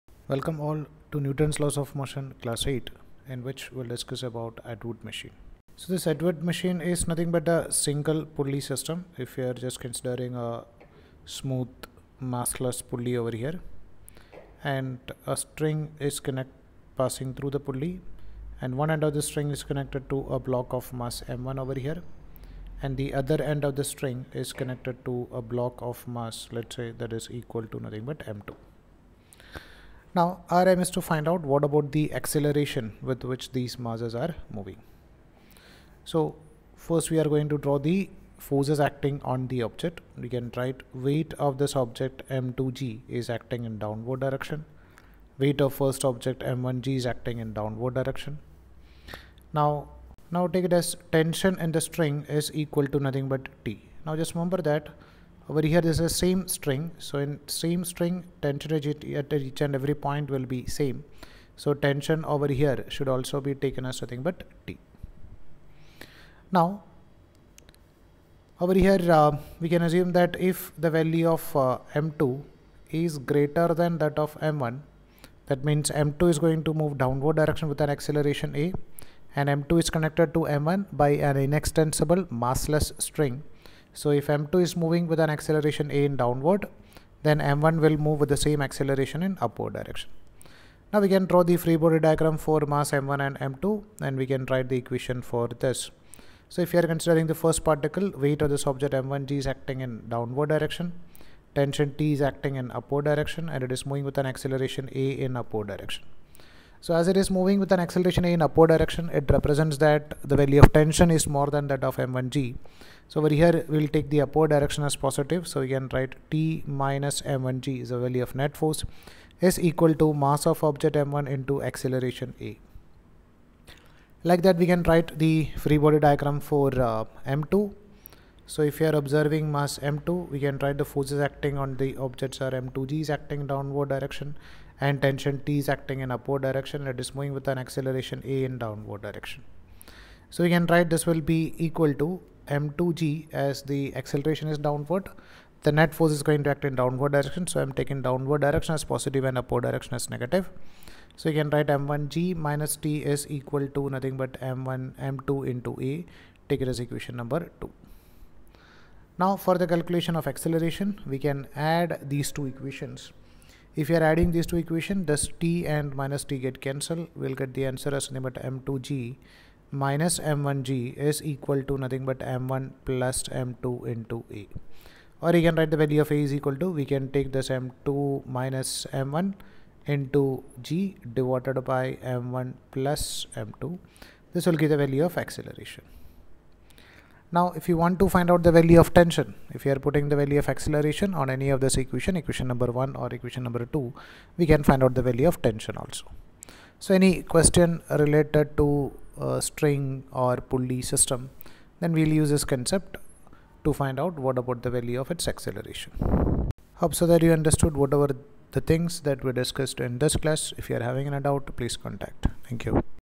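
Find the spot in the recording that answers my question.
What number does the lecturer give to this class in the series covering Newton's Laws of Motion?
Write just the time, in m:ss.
0:02.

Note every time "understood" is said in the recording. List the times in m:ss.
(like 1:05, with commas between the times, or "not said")
3:27.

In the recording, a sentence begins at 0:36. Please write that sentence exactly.
So first we are going to draw the forces acting on the object.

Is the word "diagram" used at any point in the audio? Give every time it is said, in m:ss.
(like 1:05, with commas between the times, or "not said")
1:31, 2:05.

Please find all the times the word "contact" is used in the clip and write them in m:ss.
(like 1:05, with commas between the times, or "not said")
3:31.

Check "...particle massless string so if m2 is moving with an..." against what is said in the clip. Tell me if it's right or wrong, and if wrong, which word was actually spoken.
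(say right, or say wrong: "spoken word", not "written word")
wrong: "inextensible", not "particle".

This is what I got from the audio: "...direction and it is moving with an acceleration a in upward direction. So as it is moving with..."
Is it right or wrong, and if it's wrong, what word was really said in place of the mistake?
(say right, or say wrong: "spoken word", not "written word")
right.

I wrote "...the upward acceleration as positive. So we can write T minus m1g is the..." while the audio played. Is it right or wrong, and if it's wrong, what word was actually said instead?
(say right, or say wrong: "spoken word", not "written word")
wrong: "direction", not "acceleration".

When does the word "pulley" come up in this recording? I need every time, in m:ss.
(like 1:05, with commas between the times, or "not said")
0:08, 0:12, 0:17, 3:20.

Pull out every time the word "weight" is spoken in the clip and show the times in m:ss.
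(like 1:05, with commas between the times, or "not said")
0:40, 0:45, 1:38.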